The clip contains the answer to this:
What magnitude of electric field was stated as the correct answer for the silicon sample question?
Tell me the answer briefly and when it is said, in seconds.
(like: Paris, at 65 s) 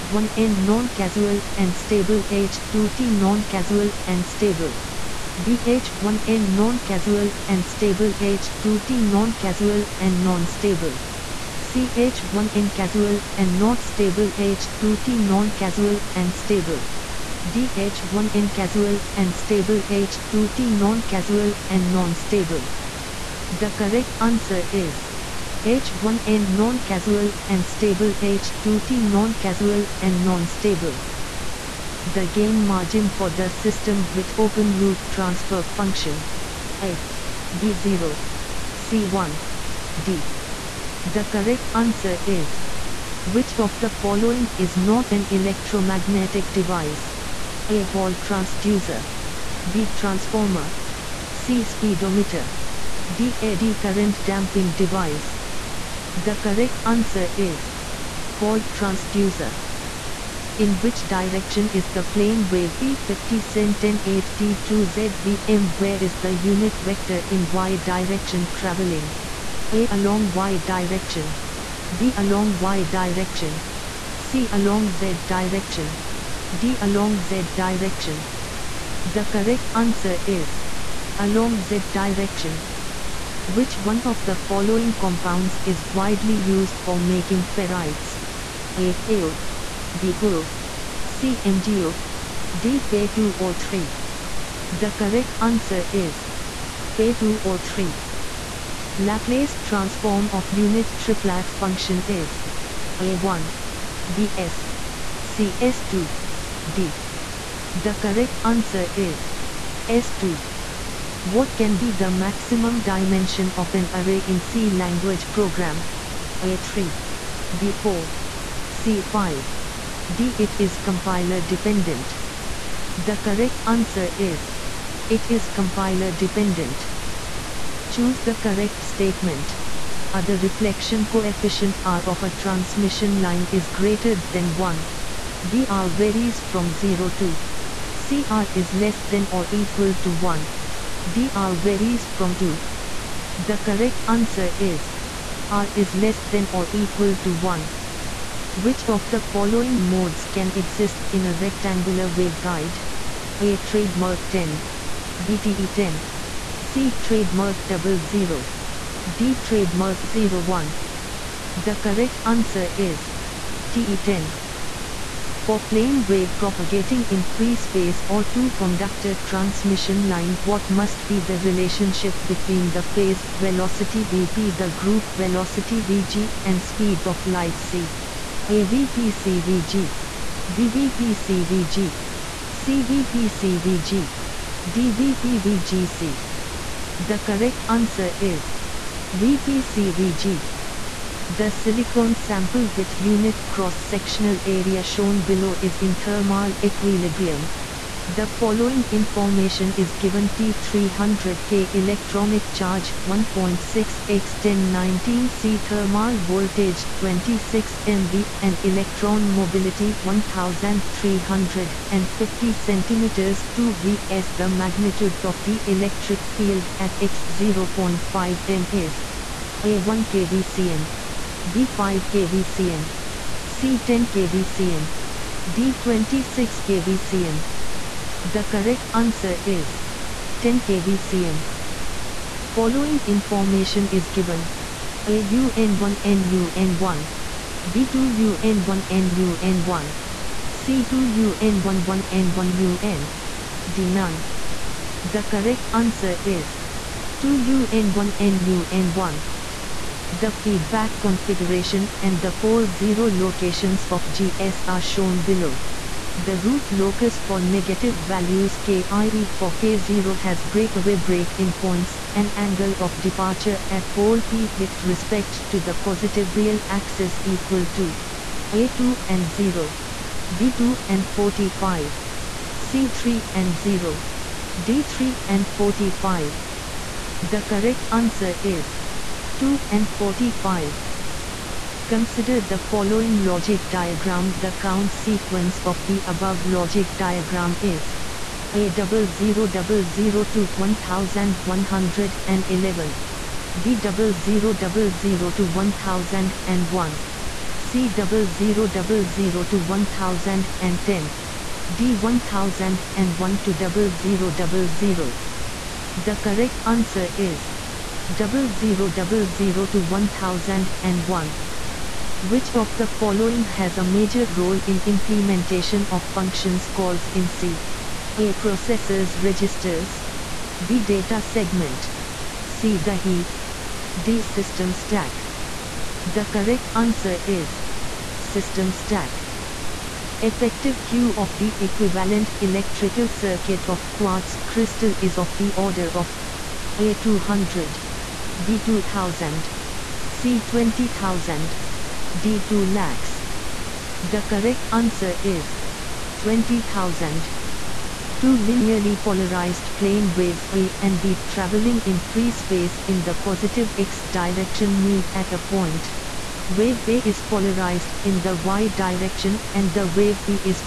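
10 kV/cm, at 230 s.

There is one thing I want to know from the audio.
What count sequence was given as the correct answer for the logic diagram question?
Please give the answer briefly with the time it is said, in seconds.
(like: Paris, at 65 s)
0000 to 1001, at 308 s.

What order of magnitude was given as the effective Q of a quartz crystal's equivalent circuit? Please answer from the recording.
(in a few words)
20,000.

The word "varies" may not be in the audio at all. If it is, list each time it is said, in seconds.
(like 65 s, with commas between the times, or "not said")
135 s, 141 s.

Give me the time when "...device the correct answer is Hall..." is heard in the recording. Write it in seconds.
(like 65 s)
54 s.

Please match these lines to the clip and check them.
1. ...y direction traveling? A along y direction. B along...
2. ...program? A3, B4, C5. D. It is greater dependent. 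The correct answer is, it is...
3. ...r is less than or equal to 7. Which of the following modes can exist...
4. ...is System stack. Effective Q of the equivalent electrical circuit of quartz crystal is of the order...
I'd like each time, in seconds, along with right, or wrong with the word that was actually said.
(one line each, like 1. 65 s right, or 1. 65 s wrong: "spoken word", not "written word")
1. 67 s right
2. 115 s wrong: "compiler", not "greater"
3. 145 s wrong: "1", not "7"
4. 327 s right.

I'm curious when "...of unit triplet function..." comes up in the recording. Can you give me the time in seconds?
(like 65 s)
100 s.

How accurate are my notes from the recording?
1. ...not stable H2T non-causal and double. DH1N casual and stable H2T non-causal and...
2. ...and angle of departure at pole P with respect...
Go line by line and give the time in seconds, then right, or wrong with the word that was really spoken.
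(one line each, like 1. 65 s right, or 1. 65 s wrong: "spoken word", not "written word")
1. 13 s wrong: "stable", not "double"
2. 262 s right.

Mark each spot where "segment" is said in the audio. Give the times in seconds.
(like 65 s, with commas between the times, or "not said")
321 s.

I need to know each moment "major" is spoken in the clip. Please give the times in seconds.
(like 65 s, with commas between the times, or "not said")
313 s.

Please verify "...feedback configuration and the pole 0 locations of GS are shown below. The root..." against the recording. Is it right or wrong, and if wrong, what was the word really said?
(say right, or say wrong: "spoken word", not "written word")
right.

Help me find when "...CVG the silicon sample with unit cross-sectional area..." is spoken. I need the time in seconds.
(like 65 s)
189 s.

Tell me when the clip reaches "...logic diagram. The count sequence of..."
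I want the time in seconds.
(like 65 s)
283 s.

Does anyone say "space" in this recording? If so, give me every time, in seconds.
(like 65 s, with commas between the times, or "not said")
167 s, 352 s.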